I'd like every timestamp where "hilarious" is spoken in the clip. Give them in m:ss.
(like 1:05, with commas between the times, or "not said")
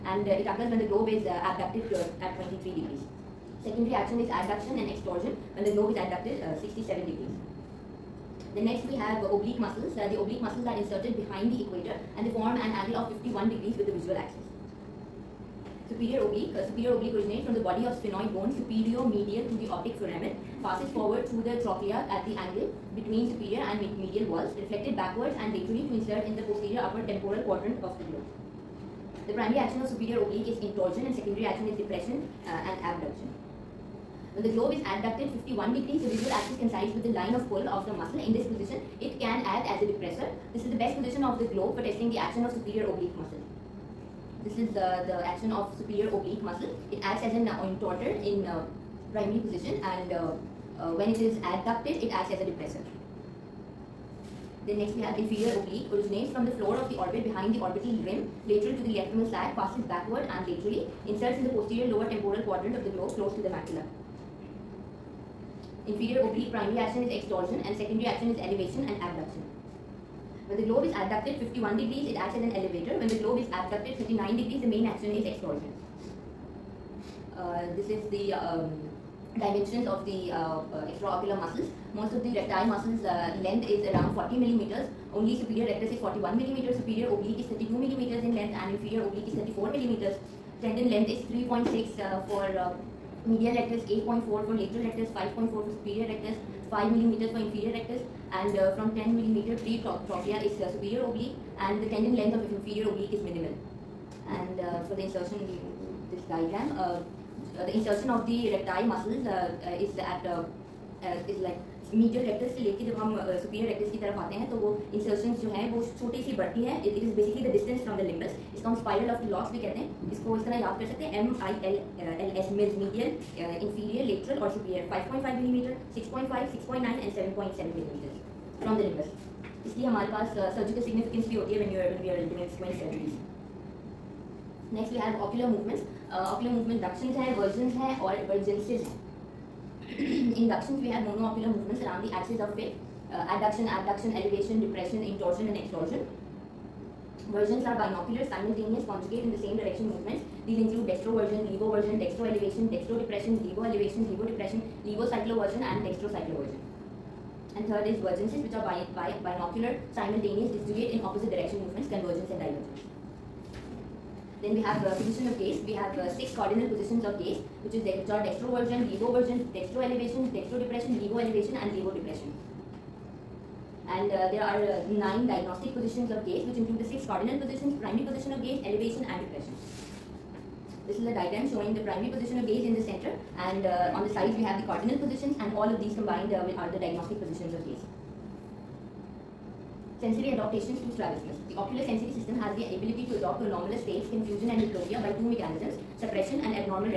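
not said.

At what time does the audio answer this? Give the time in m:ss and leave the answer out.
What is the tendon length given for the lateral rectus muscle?
1:33.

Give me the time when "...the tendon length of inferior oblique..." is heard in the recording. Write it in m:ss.
1:41.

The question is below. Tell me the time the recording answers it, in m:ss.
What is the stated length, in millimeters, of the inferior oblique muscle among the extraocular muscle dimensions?
1:29.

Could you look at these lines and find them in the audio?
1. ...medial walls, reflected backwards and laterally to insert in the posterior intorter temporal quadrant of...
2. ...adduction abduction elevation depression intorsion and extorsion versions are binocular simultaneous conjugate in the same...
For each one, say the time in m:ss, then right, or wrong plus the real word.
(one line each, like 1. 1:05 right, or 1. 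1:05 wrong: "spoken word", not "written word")
1. 0:23 wrong: "upper", not "intorter"
2. 2:23 right.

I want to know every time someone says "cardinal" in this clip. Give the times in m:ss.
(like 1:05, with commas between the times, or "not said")
2:46, 2:57, 3:04.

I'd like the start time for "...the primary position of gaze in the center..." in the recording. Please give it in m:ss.
3:01.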